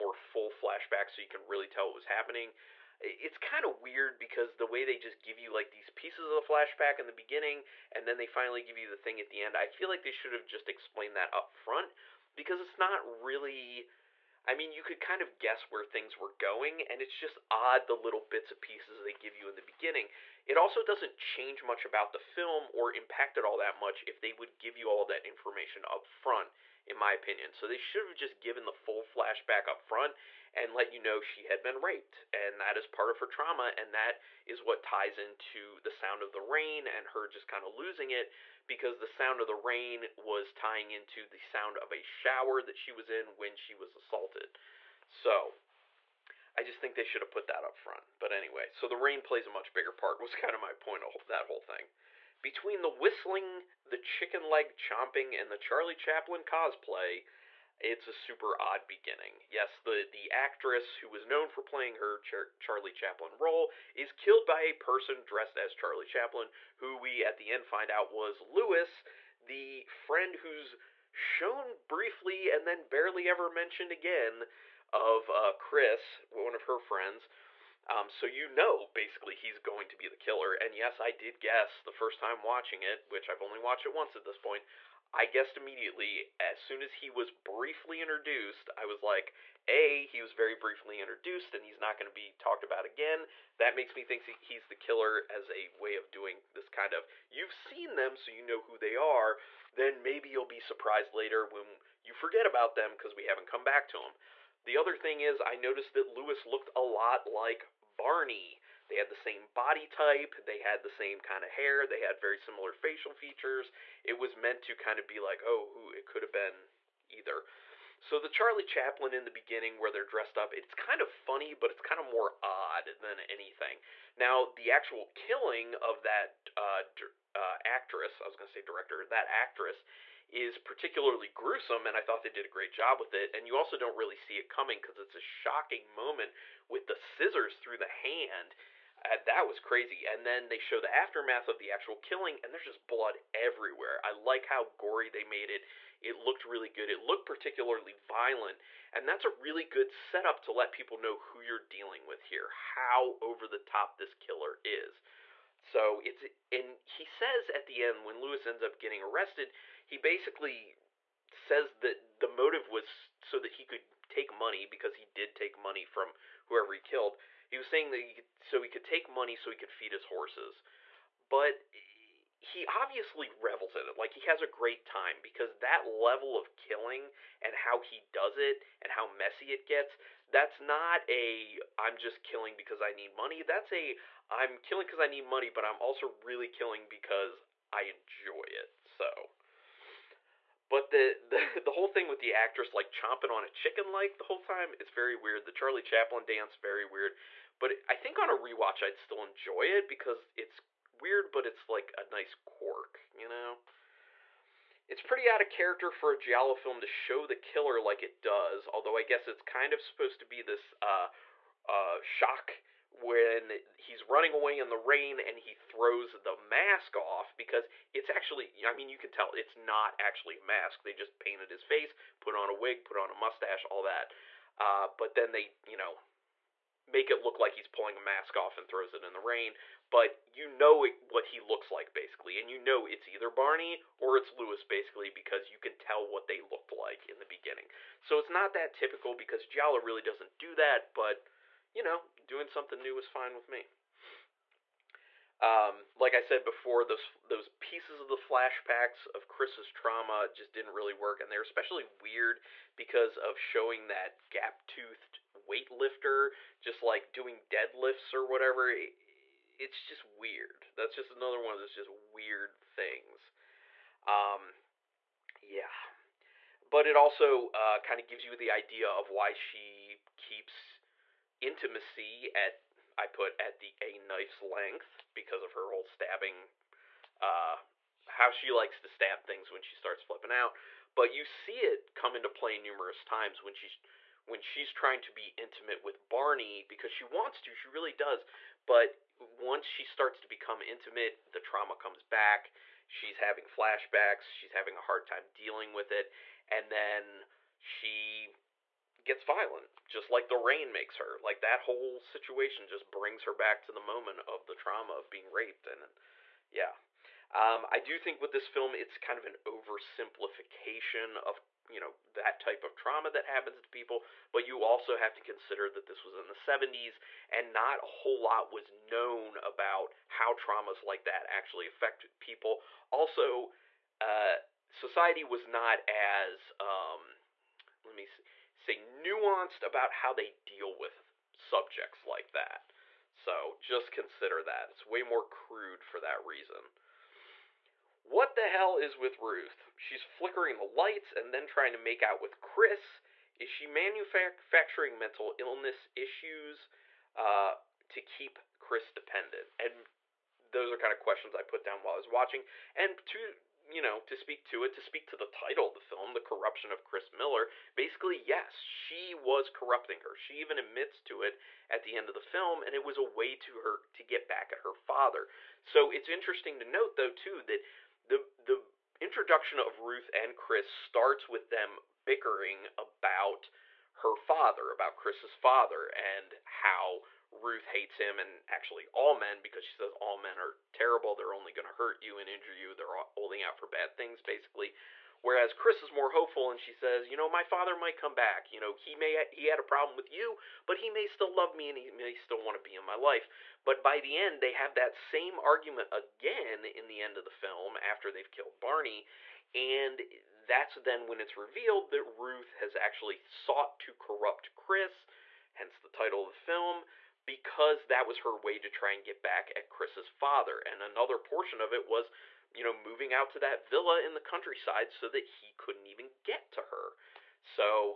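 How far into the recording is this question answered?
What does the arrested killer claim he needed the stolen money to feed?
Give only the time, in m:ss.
2:49.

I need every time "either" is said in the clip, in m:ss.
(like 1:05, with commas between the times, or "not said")
1:57, 3:53.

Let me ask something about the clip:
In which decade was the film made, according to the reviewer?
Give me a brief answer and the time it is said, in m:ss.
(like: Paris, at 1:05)
70s, at 5:16.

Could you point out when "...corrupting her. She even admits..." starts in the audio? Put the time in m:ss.
5:59.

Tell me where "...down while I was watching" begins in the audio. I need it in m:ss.
5:51.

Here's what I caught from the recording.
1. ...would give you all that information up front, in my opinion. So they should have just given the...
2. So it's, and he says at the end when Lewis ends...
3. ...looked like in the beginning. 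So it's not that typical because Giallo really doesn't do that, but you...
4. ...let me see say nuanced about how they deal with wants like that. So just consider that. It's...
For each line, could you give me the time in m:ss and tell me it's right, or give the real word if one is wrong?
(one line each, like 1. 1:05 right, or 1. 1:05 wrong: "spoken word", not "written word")
1. 0:24 right
2. 2:35 right
3. 3:56 right
4. 5:27 wrong: "subjects", not "wants".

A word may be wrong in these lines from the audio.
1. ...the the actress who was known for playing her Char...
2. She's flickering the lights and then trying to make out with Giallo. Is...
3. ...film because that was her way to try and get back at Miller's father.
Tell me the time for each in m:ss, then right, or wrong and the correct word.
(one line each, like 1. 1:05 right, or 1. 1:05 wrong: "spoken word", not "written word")
1. 0:59 right
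2. 5:39 wrong: "Chris", not "Giallo"
3. 6:46 wrong: "Chris", not "Miller".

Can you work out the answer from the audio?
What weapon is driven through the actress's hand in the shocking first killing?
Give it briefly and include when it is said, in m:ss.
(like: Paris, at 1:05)
scissors, at 2:16.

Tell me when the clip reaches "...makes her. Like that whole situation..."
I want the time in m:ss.
5:00.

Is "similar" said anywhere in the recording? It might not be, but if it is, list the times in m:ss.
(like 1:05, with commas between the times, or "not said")
1:52.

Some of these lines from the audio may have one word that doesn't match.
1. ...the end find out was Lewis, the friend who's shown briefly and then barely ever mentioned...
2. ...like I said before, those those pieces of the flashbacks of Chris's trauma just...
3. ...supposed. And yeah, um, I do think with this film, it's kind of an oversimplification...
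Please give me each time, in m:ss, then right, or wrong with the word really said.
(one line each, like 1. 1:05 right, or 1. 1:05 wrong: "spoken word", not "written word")
1. 1:07 right
2. 4:05 right
3. 5:05 wrong: "raped", not "supposed".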